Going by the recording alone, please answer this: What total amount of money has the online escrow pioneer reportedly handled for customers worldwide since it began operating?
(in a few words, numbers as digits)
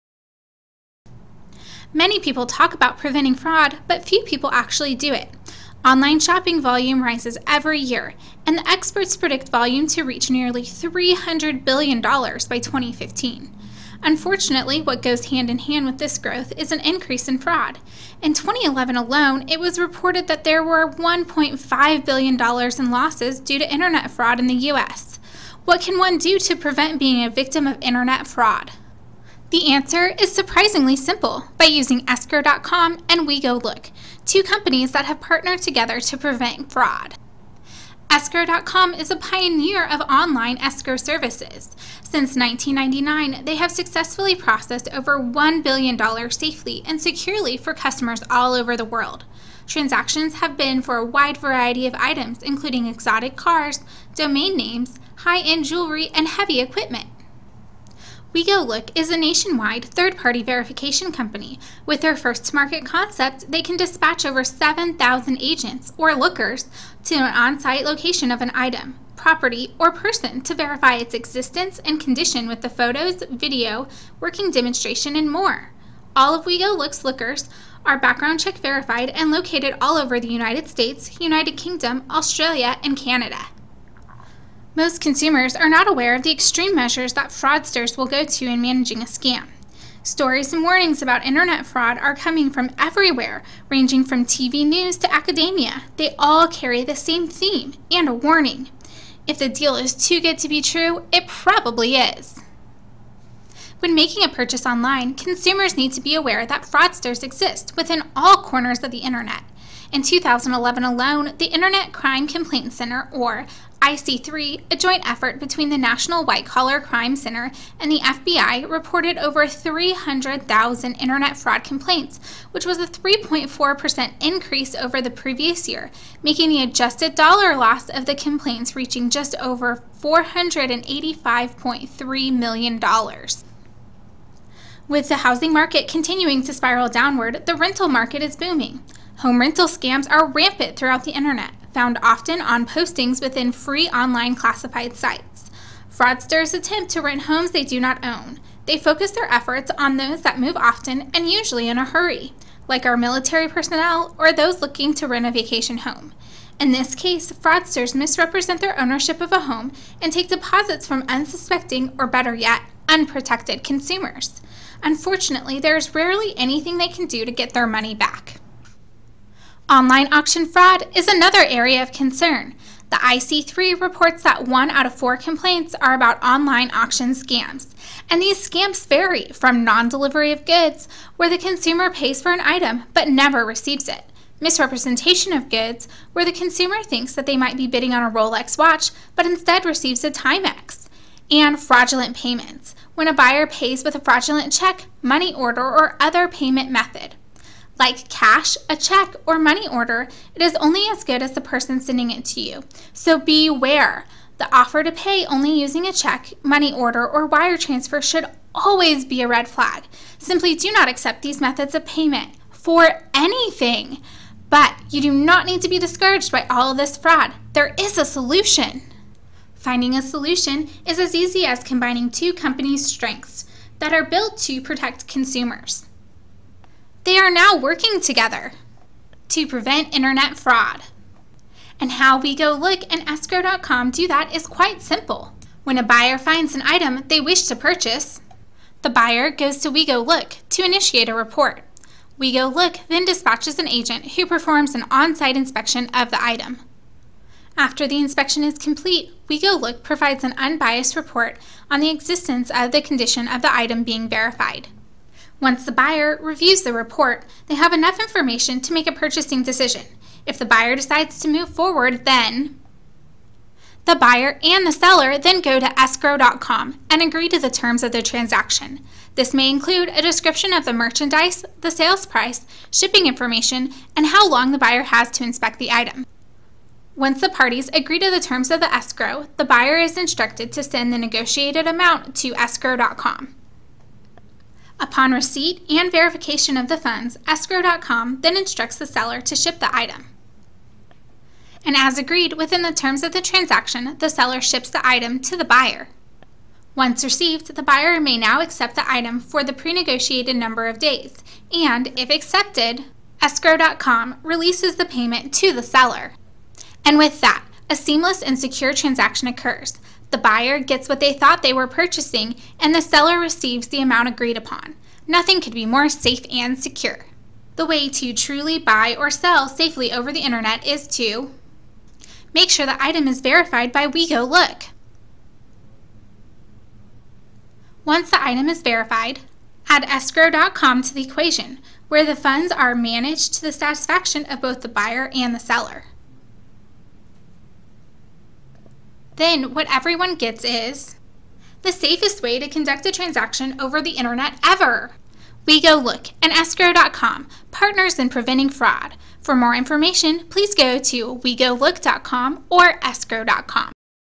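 over $1 billion.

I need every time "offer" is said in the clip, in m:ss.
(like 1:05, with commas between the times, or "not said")
3:24.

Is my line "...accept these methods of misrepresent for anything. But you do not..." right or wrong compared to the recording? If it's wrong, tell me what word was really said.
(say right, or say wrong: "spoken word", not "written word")
wrong: "payment", not "misrepresent".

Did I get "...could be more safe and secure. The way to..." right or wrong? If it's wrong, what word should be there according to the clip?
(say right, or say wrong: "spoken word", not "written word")
right.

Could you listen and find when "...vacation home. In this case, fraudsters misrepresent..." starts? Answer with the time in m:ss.
2:35.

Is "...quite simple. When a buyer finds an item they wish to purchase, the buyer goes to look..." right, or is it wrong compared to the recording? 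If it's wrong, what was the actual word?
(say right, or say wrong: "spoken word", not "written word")
right.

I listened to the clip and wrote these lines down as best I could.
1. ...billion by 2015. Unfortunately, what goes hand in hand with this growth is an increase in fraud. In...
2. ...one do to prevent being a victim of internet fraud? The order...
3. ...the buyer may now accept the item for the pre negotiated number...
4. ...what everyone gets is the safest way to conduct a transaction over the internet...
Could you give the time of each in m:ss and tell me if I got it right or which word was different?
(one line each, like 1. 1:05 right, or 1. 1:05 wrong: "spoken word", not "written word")
1. 0:11 right
2. 0:25 wrong: "answer", not "order"
3. 4:57 right
4. 5:39 right.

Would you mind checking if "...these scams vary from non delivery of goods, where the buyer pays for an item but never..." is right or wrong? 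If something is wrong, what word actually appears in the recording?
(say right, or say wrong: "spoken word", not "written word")
wrong: "consumer", not "buyer".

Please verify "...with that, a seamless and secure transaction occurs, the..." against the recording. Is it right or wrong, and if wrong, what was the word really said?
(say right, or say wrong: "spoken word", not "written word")
right.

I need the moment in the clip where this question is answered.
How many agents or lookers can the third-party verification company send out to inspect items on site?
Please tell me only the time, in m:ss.
1:04.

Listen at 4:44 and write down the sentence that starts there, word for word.
Upon receipt and verification of the funds, escrow.com then instructs the seller to ship the item.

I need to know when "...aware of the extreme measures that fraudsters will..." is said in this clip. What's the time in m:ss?
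1:25.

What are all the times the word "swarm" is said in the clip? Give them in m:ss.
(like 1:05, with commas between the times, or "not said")
not said.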